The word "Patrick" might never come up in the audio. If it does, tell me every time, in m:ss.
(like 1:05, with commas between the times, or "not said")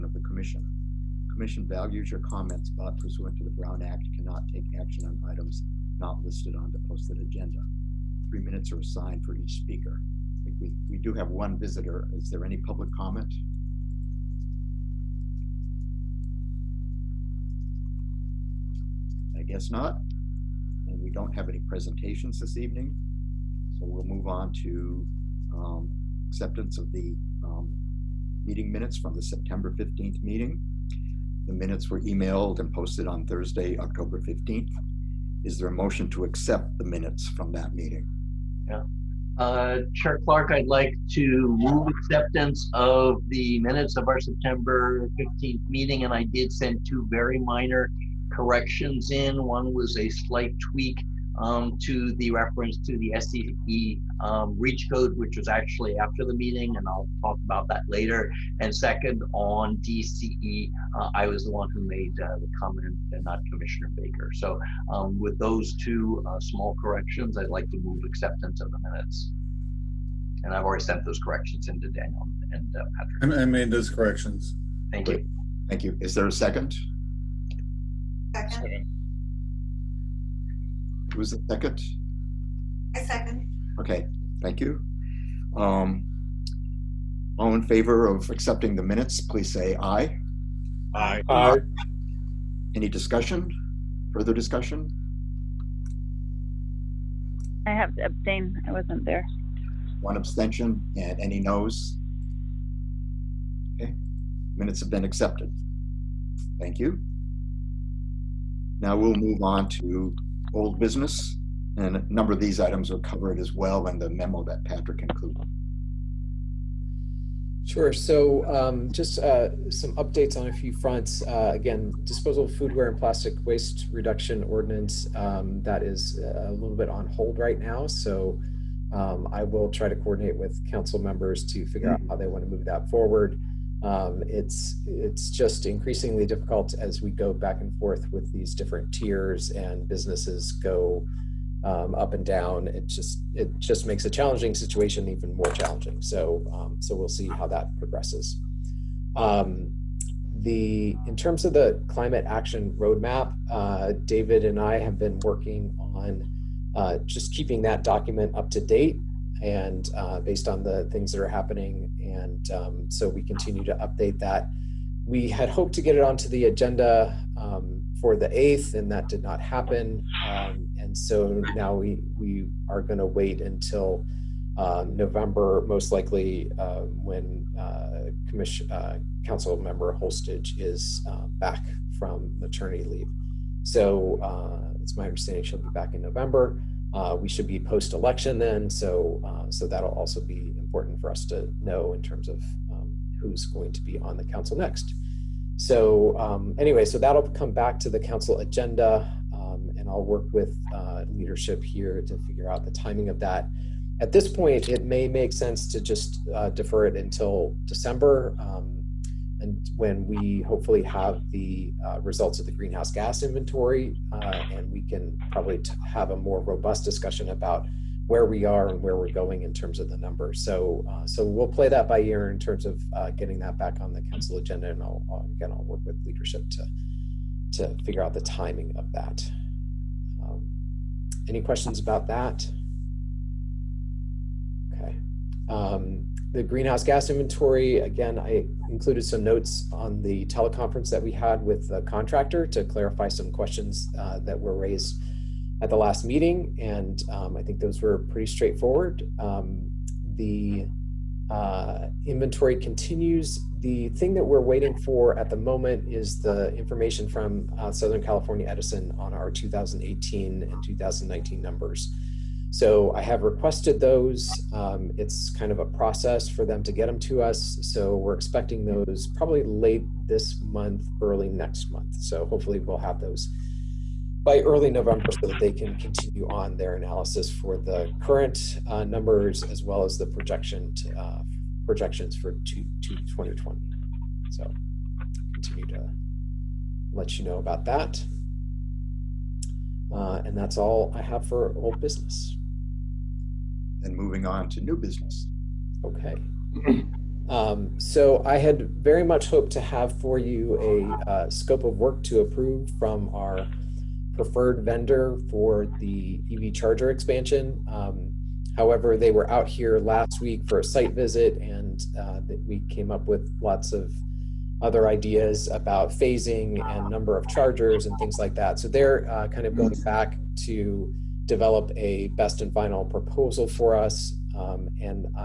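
1:13, 1:54.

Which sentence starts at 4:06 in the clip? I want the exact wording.
And um, I think those were pretty straightforward.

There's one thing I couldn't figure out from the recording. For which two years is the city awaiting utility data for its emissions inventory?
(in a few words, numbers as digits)
2018 and 2019.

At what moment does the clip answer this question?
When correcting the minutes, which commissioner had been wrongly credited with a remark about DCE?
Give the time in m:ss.
1:03.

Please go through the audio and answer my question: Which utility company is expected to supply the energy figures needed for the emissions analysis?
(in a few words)
Southern California Edison.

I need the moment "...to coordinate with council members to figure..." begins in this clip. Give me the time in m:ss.
2:09.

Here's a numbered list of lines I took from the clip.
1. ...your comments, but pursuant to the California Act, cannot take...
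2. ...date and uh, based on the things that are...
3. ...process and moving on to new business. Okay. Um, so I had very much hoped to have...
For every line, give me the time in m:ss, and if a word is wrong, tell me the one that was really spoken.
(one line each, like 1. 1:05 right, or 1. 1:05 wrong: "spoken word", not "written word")
1. 0:02 wrong: "Brown", not "California"
2. 2:38 right
3. 4:51 wrong: "business", not "process".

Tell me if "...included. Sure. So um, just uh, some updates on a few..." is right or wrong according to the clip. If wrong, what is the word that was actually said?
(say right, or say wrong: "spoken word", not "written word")
right.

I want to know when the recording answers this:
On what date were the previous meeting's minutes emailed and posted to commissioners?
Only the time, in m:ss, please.
0:33.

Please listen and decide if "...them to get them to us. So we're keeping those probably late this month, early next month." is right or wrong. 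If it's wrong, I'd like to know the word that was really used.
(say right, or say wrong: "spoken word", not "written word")
wrong: "expecting", not "keeping".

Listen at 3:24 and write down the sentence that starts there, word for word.
At this point, it may make sense to just uh, defer it until December.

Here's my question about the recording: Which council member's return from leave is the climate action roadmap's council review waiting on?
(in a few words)
Holstege.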